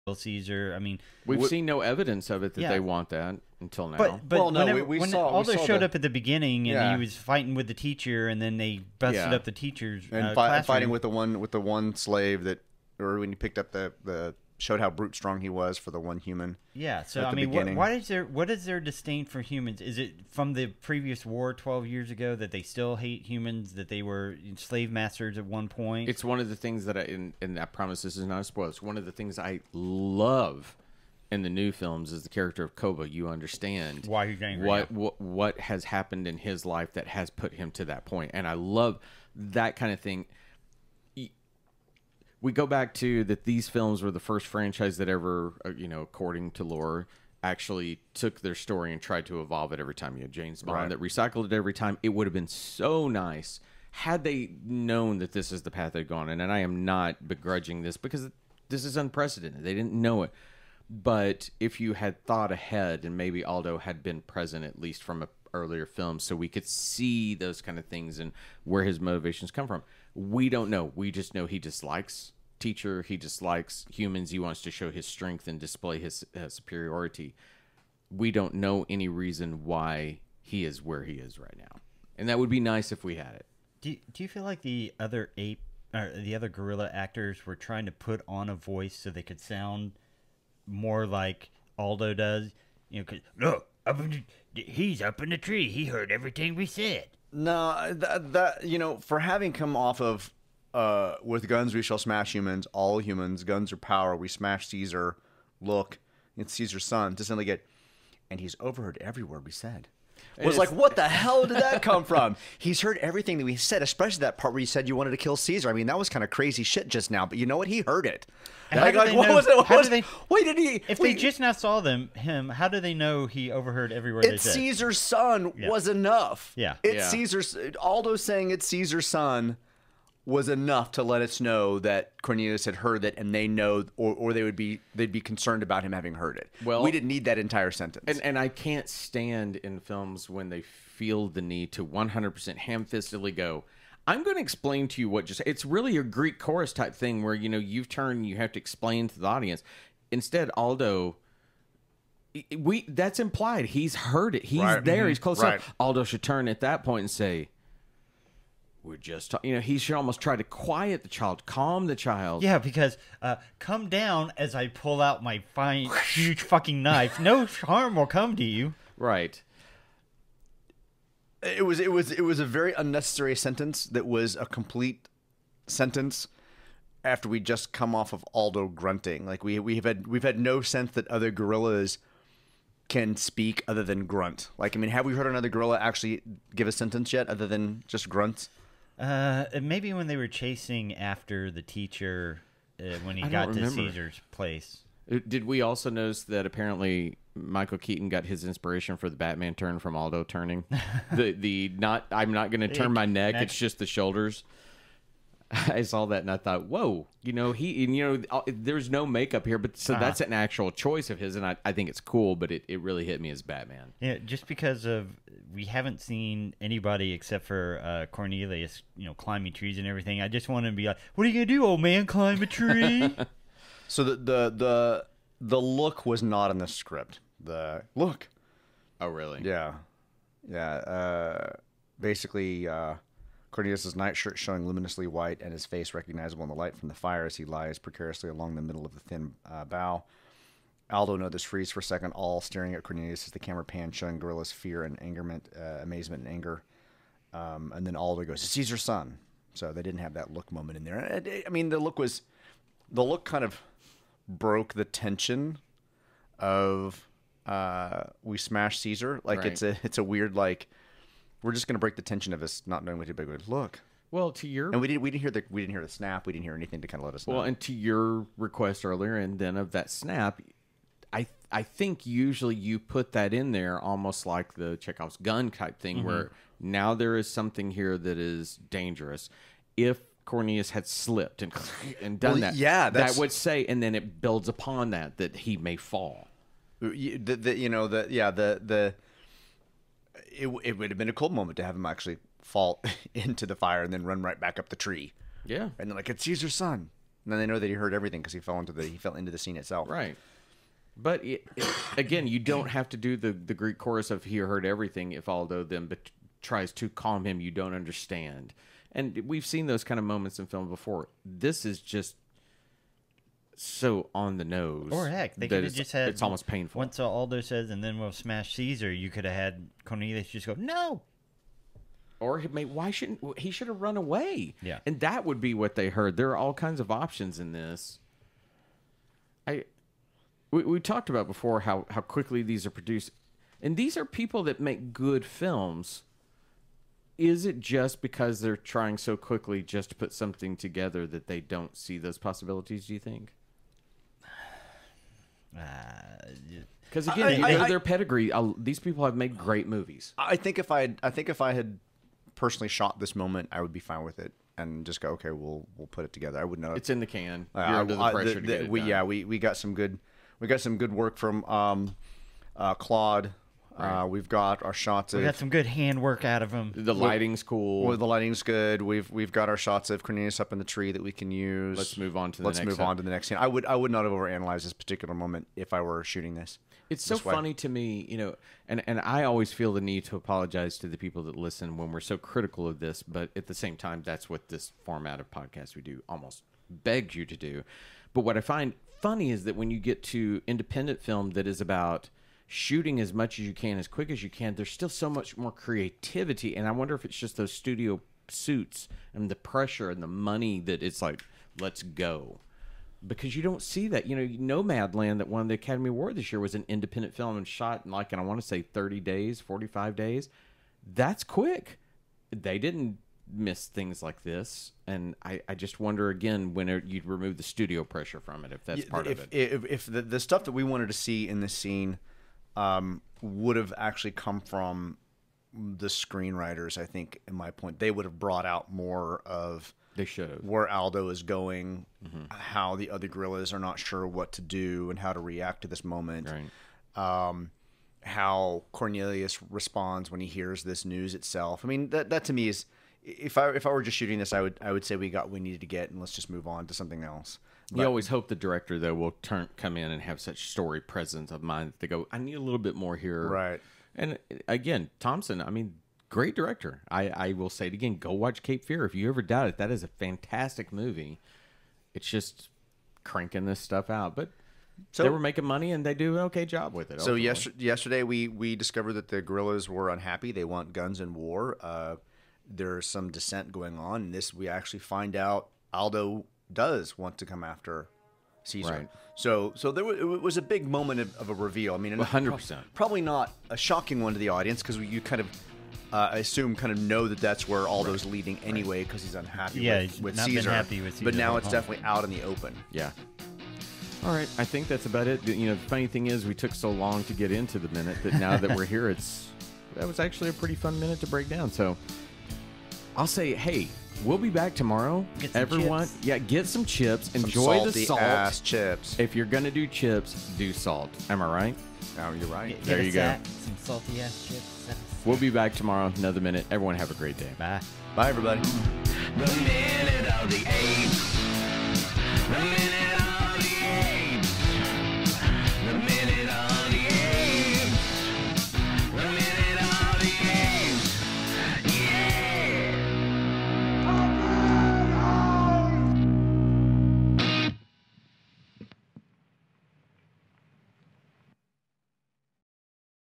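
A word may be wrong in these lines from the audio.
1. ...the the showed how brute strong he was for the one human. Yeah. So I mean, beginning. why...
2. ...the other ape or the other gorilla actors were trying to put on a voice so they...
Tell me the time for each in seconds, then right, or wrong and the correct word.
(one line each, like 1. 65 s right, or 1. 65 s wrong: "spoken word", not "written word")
1. 13 s right
2. 84 s right.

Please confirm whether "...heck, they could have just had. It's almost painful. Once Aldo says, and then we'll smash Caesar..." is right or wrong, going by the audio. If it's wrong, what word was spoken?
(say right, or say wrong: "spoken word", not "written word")
right.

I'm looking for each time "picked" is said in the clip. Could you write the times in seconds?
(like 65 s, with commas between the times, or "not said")
13 s.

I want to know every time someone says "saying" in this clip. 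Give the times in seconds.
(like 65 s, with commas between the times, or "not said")
128 s.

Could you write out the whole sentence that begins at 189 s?
Uh, maybe when they were chasing after the teacher uh, when he I got to remember.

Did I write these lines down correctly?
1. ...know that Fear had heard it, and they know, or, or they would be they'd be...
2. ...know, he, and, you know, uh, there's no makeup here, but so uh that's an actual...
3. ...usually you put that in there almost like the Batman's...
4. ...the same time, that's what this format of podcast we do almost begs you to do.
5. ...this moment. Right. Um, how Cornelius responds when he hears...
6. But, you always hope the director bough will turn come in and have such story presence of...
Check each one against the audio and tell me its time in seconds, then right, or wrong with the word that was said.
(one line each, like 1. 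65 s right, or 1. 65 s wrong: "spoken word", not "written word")
1. 131 s wrong: "Cornelius", not "Fear"
2. 207 s right
3. 272 s wrong: "Chekhov", not "Batman"
4. 383 s right
5. 435 s right
6. 447 s wrong: "though", not "bough".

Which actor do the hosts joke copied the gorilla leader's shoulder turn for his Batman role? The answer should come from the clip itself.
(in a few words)
Michael Keaton.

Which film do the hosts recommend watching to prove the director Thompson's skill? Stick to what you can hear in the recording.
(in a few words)
Cape Fear.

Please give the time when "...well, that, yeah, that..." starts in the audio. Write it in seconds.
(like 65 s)
282 s.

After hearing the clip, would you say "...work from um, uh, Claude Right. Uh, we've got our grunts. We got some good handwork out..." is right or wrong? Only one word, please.
wrong.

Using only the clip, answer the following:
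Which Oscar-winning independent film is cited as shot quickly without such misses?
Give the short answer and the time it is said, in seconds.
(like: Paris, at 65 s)
Nomadland, at 404 s.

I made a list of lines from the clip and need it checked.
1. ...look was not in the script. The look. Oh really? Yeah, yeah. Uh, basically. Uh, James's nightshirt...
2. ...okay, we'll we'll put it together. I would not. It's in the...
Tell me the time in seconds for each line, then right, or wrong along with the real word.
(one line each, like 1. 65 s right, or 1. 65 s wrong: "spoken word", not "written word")
1. 225 s wrong: "Cornelius", not "James"
2. 355 s right.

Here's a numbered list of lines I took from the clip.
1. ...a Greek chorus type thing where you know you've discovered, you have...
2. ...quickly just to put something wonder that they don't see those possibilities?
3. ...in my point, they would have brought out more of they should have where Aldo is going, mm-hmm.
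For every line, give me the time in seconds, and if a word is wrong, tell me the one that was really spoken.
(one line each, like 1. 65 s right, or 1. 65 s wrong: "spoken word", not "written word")
1. 145 s wrong: "turned", not "discovered"
2. 339 s wrong: "together", not "wonder"
3. 427 s right.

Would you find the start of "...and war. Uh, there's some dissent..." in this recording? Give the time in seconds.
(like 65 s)
470 s.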